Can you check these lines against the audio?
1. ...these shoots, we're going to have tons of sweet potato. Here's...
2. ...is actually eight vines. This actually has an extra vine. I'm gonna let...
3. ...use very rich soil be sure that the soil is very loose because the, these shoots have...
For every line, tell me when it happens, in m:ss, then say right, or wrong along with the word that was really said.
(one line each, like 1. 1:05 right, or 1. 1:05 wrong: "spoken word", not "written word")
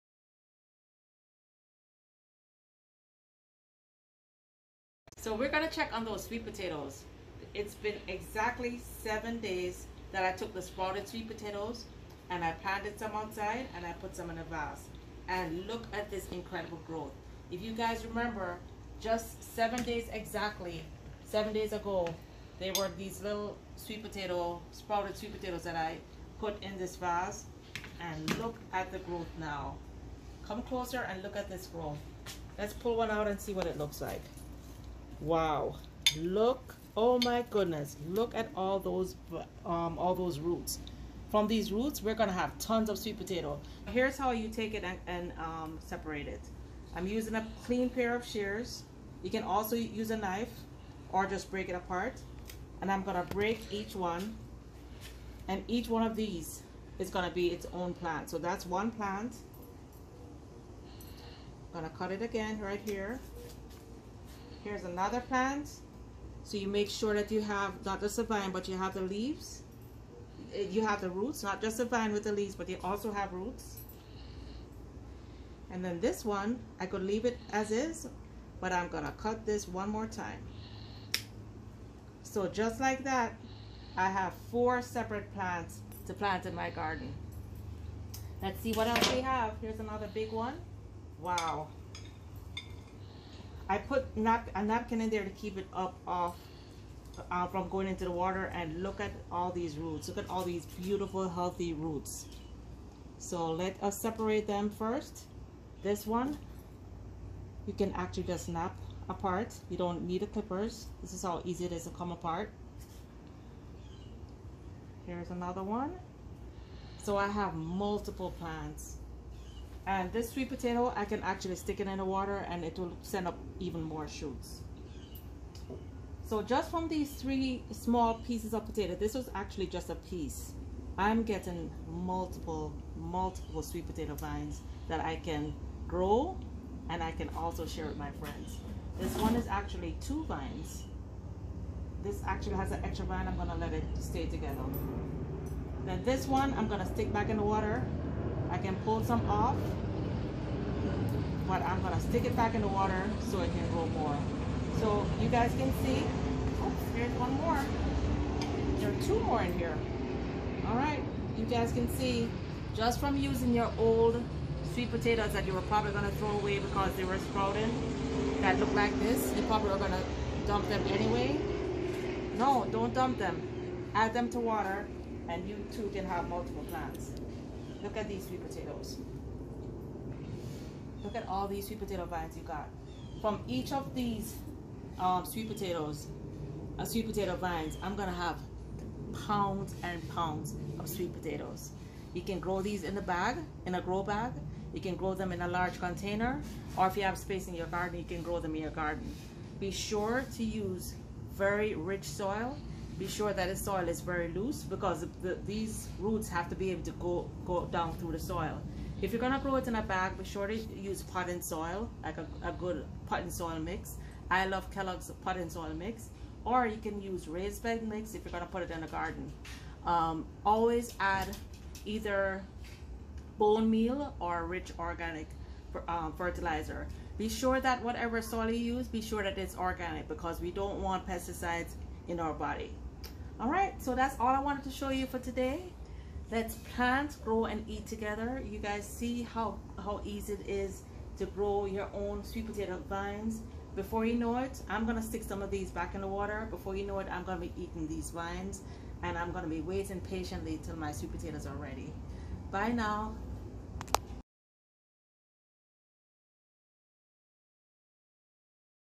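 1. 0:41 wrong: "roots", not "shoots"
2. 2:19 wrong: "two", not "eight"
3. 3:20 wrong: "roots", not "shoots".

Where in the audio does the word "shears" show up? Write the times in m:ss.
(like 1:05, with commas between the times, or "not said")
0:48.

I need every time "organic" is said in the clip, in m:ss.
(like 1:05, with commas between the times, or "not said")
3:44, 3:49.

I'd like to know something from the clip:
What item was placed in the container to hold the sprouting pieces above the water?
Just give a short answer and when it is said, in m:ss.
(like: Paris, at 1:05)
A napkin, at 1:34.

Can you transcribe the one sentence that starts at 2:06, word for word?
So just from these three small pieces of potato, this was actually just a piece.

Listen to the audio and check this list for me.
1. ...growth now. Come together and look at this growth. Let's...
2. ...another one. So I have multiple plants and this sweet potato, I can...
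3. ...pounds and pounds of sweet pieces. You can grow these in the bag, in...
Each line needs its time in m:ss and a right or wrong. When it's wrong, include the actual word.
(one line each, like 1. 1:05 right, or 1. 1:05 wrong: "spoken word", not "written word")
1. 0:28 wrong: "closer", not "together"
2. 1:55 right
3. 3:09 wrong: "potatoes", not "pieces".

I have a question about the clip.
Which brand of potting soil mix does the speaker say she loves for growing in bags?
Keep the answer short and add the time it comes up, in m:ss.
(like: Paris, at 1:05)
Kellogg's, at 3:34.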